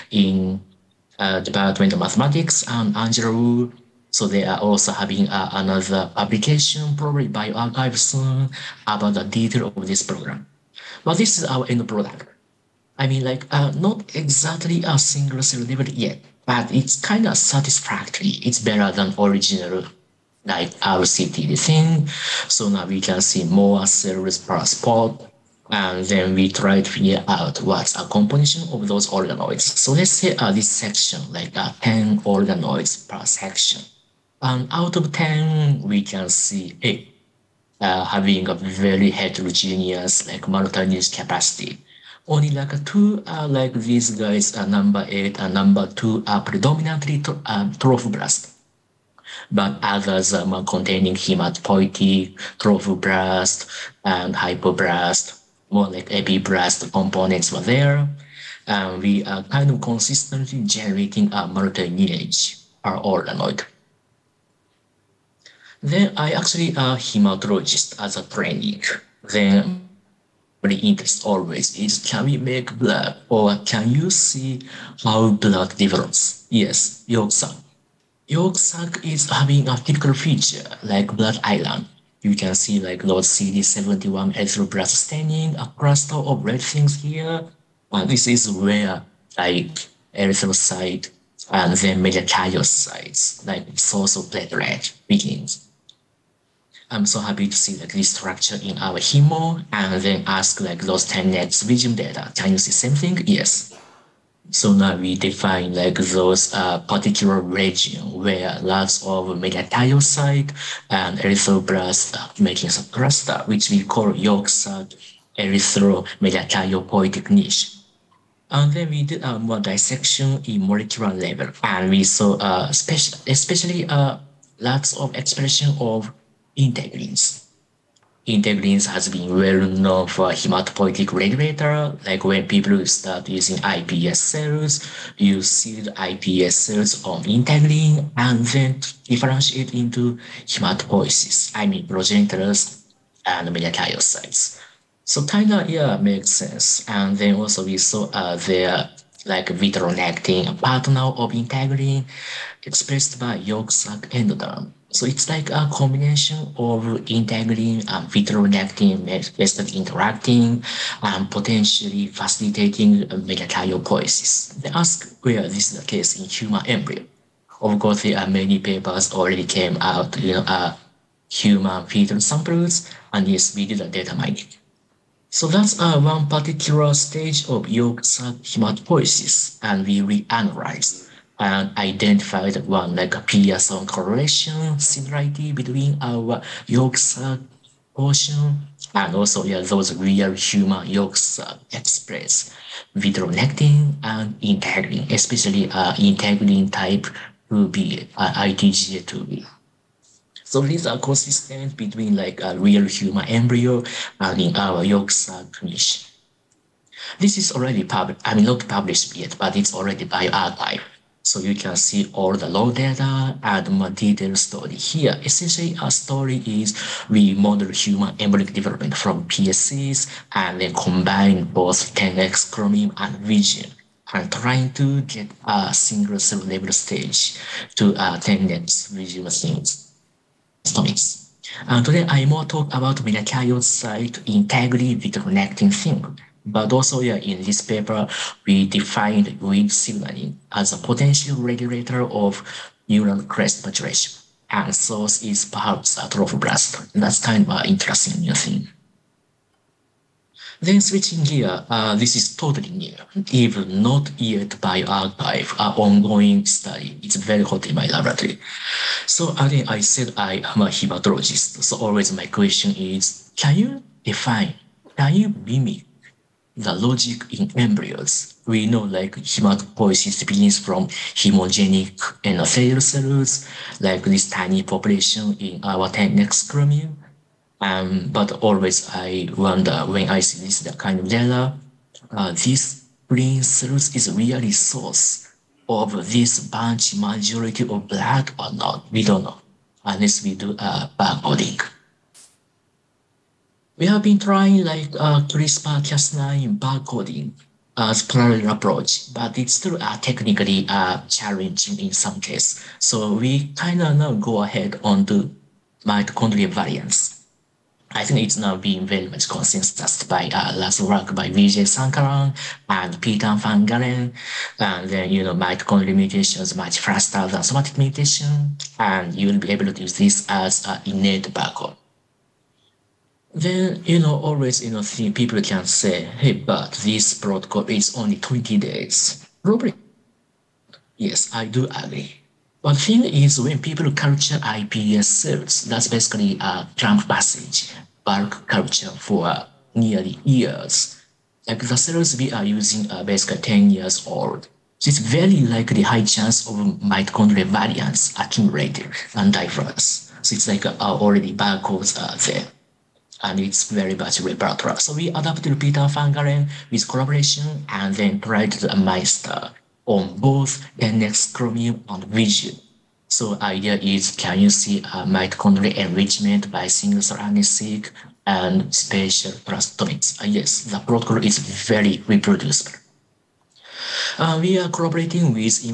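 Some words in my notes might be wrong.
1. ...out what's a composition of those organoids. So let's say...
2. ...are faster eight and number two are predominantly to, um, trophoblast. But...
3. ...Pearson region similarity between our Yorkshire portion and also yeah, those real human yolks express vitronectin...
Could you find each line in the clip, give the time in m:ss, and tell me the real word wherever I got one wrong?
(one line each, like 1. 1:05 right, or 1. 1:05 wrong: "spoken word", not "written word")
1. 0:27 right
2. 0:44 wrong: "number", not "faster"
3. 3:03 wrong: "correlation", not "region".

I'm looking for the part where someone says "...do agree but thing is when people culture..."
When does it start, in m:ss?
5:31.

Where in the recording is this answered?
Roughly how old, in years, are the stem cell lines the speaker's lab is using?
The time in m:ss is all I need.
5:43.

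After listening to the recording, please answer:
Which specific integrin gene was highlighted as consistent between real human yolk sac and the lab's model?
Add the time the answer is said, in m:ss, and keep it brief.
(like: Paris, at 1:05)
ITGA2B, at 3:18.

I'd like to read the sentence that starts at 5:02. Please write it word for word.
So we kind of now go ahead on the mitochondrial variants.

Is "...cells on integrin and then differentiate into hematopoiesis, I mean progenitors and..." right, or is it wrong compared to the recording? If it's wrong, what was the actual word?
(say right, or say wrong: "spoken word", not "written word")
right.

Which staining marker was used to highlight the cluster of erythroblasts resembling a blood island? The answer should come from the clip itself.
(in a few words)
CD71.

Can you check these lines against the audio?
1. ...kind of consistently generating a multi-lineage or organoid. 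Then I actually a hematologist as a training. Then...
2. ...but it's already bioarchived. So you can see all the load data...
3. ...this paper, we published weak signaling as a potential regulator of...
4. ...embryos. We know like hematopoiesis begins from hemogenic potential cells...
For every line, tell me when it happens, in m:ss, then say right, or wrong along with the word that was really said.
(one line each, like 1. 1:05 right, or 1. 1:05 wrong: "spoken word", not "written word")
1. 0:59 right
2. 3:29 right
3. 3:57 wrong: "defined", not "published"
4. 4:27 wrong: "endothelial", not "potential".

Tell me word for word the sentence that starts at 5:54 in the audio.
So we adapted Peter van Galen with collaboration and then tried the MAESTER on both NX Chromium and Visium.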